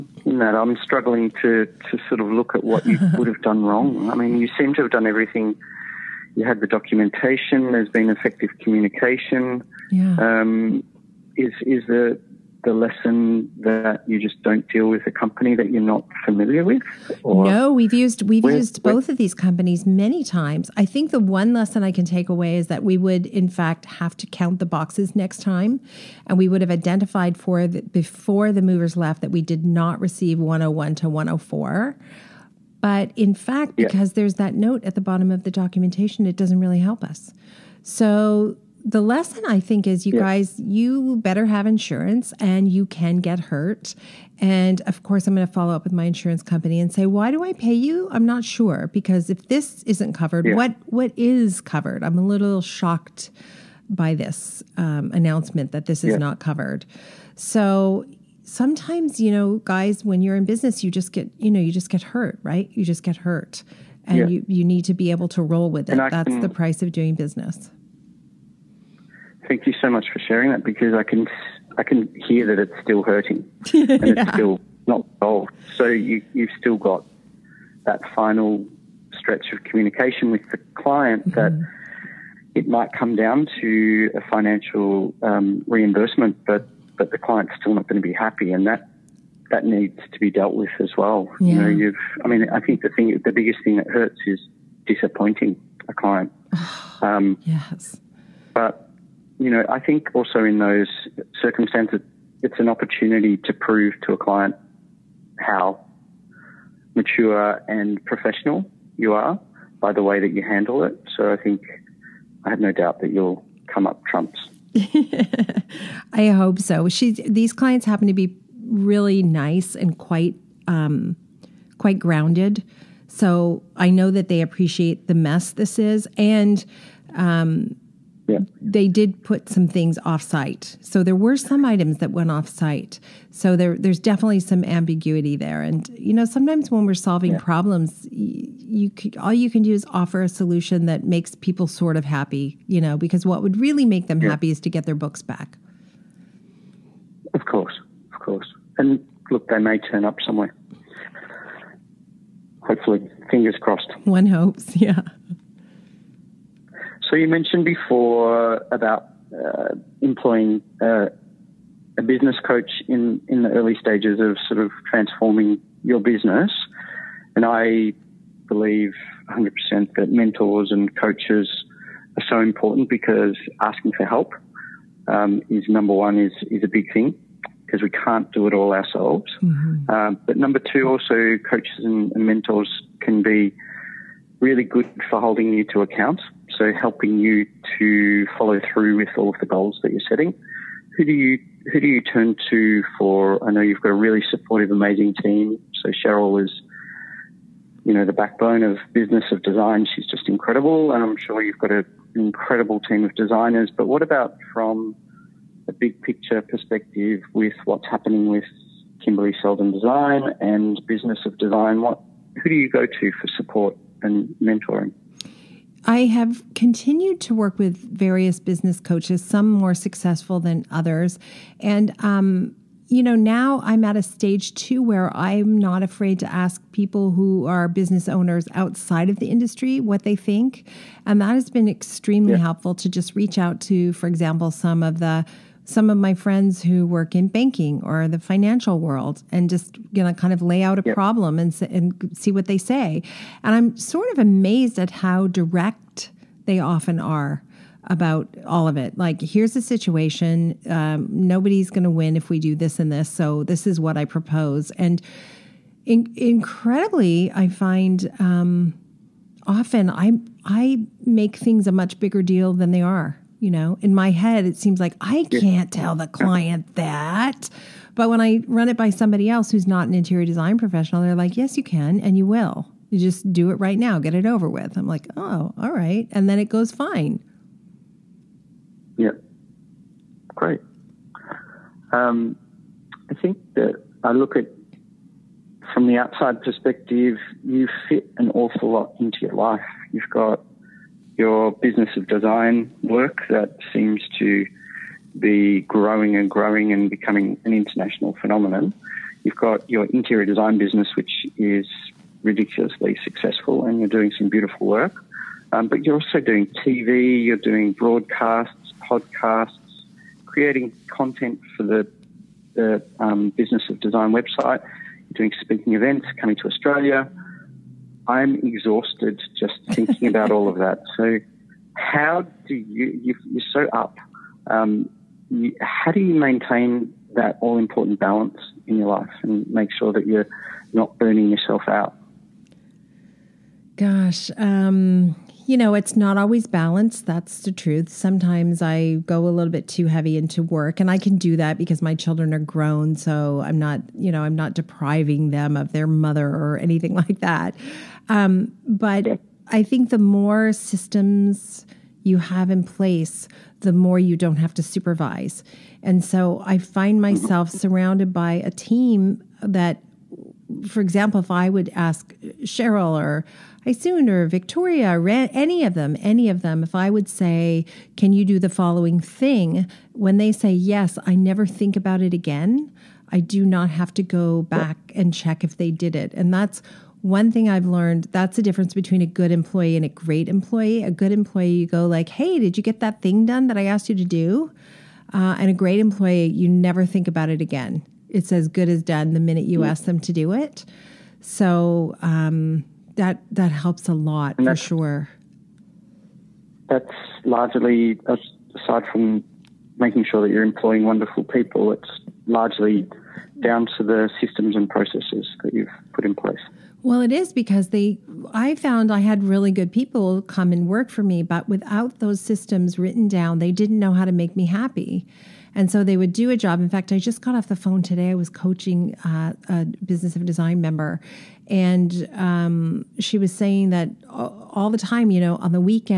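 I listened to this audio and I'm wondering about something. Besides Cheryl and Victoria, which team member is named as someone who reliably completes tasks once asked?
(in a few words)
Isun.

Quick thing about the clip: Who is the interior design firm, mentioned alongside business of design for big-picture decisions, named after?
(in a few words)
Kimberley Seldon.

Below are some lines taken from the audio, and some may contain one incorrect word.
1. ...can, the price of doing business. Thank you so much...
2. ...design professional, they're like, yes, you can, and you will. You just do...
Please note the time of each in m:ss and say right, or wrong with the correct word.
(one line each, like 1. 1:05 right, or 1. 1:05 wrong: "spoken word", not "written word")
1. 1:06 right
2. 4:30 right.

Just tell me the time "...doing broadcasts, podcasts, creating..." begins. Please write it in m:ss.
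5:07.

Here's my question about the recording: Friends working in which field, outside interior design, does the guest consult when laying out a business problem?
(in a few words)
Banking.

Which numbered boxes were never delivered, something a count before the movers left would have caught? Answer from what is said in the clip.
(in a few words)
101 to 104.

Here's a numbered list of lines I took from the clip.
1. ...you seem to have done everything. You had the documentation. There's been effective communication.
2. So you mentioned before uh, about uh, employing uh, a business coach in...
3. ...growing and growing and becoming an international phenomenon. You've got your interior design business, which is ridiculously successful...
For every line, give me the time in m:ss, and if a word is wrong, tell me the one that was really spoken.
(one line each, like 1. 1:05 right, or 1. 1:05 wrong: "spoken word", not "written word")
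1. 0:04 right
2. 2:37 right
3. 4:55 right.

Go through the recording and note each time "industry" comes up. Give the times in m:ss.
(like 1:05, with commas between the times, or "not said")
3:49.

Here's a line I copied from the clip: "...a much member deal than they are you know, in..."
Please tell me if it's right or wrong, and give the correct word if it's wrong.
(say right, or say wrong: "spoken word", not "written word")
wrong: "bigger", not "member".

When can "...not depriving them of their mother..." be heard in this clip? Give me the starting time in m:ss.
5:44.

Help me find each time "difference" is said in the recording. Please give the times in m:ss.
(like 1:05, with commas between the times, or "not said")
6:18.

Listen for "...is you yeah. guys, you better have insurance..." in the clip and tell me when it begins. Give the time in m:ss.
0:39.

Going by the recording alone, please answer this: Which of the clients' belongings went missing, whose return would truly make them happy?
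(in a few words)
Books.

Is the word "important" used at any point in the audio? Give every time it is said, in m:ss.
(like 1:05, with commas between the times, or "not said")
2:52, 5:27.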